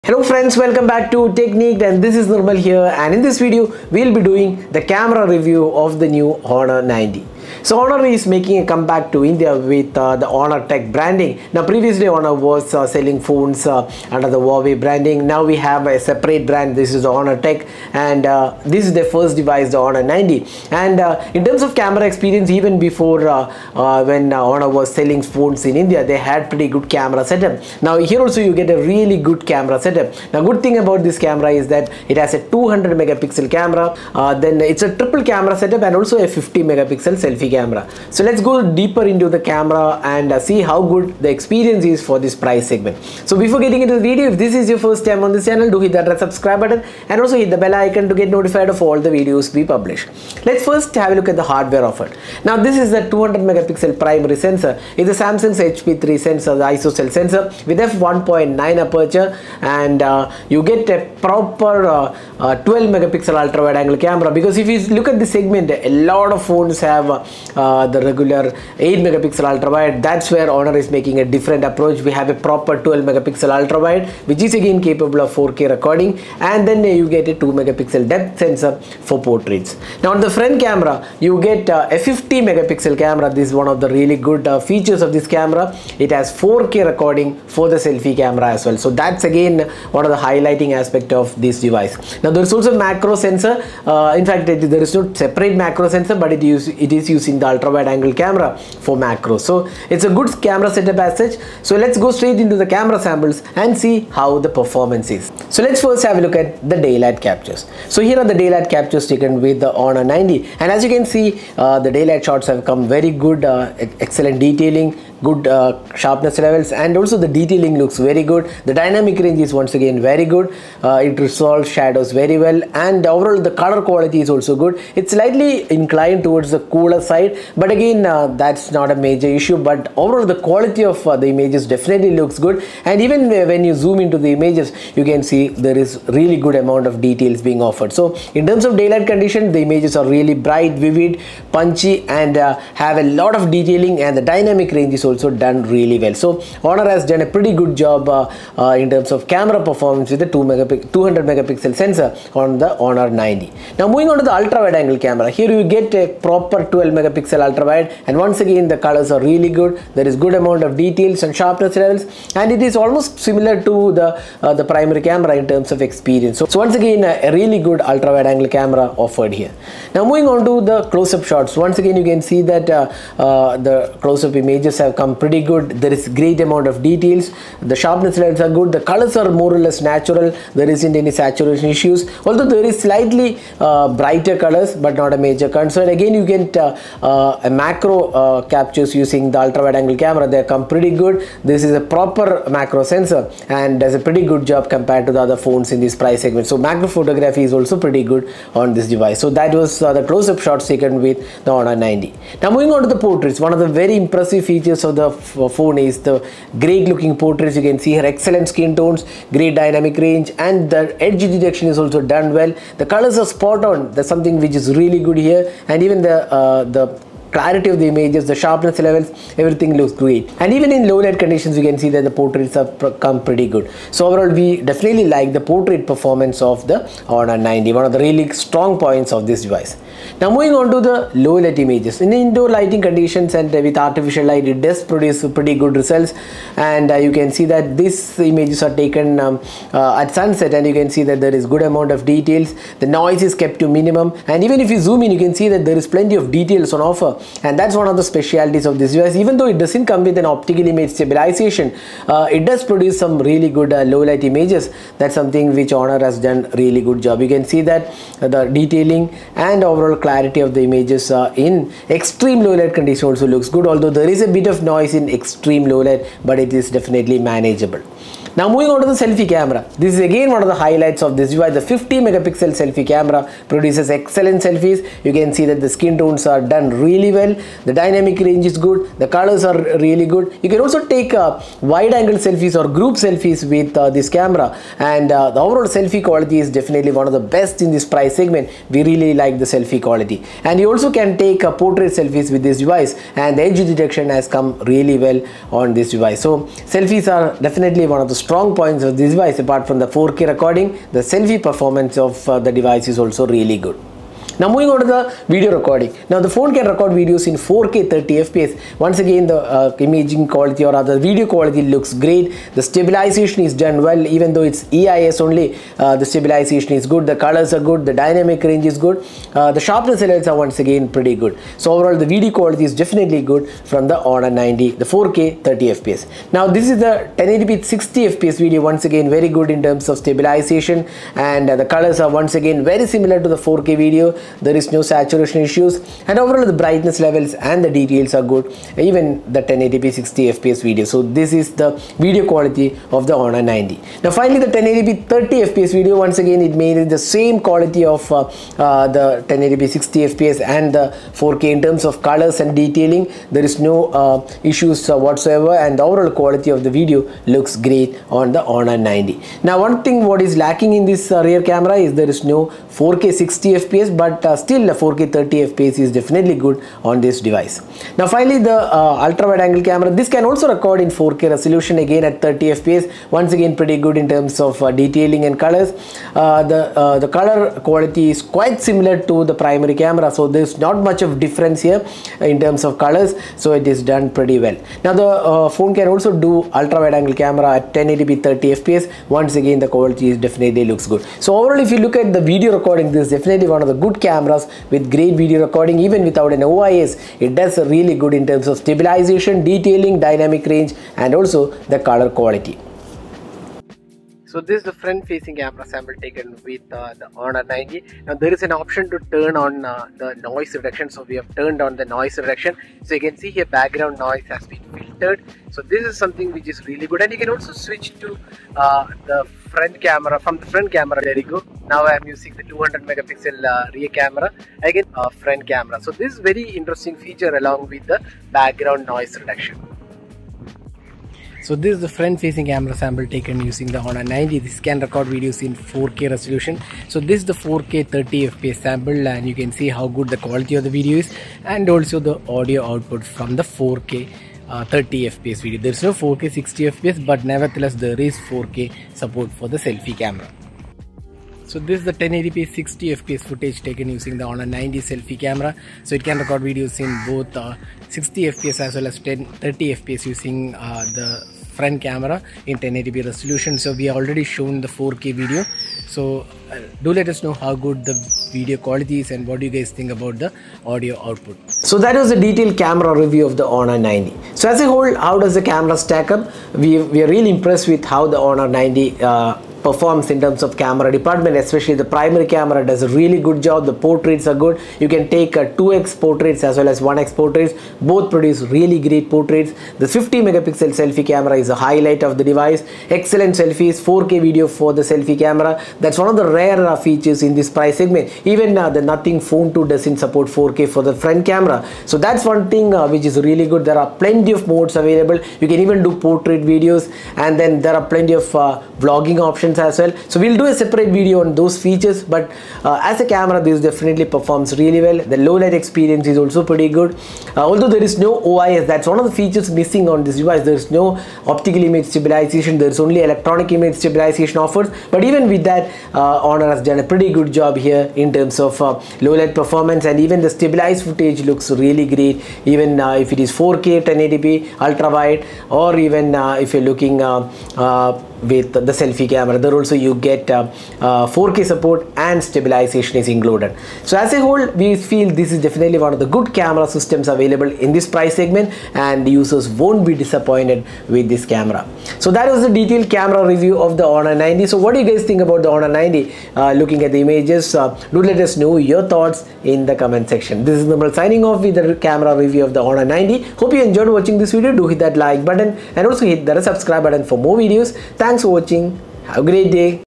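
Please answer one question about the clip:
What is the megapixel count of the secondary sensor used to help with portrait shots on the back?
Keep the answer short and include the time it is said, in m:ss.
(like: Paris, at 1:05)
2 megapixel, at 1:17.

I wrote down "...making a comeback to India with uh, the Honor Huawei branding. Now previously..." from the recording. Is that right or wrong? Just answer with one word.
wrong.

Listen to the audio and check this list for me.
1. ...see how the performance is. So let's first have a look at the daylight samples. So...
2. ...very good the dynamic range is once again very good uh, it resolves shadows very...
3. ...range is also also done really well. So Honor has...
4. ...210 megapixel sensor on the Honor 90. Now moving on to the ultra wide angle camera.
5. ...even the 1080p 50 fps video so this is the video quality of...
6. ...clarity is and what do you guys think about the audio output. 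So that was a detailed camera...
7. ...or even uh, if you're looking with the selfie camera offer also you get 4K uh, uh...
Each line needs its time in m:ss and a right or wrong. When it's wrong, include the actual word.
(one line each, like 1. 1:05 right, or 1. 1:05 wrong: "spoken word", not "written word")
1. 1:43 wrong: "captures", not "samples"
2. 1:57 right
3. 2:24 right
4. 2:30 wrong: "200", not "210"
5. 5:38 wrong: "60", not "50"
6. 7:48 wrong: "quality", not "clarity"
7. 8:55 wrong: "whether", not "offer".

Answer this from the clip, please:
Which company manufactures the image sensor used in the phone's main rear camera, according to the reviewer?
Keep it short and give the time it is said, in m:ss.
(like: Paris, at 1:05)
Samsung, at 0:55.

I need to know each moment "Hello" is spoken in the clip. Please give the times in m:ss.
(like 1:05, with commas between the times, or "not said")
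0:00.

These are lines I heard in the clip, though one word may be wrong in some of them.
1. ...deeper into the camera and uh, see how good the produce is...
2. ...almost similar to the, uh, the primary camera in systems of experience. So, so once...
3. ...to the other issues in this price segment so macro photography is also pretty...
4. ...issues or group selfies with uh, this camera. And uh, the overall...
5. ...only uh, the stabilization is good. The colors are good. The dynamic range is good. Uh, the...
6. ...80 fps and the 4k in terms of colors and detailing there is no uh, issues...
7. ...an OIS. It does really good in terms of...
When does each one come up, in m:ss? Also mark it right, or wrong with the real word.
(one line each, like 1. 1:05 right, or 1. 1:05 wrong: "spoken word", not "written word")
1. 0:38 wrong: "experience", not "produce"
2. 2:42 wrong: "terms", not "systems"
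3. 3:15 wrong: "phones", not "issues"
4. 4:42 wrong: "selfies", not "issues"
5. 5:15 right
6. 5:49 wrong: "60", not "80"
7. 6:36 right.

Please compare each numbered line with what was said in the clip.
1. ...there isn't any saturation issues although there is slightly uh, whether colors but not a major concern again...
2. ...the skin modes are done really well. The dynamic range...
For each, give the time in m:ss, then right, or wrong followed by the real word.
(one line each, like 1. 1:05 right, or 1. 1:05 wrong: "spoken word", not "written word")
1. 3:00 wrong: "brighter", not "whether"
2. 4:35 wrong: "tones", not "modes".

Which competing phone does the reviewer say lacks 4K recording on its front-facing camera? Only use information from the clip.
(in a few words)
Nothing Phone 2.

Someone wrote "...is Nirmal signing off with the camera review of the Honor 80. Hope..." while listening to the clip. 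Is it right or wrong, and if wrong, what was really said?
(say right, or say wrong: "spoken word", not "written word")
wrong: "90", not "80".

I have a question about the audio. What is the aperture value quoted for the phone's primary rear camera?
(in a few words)
f1.9.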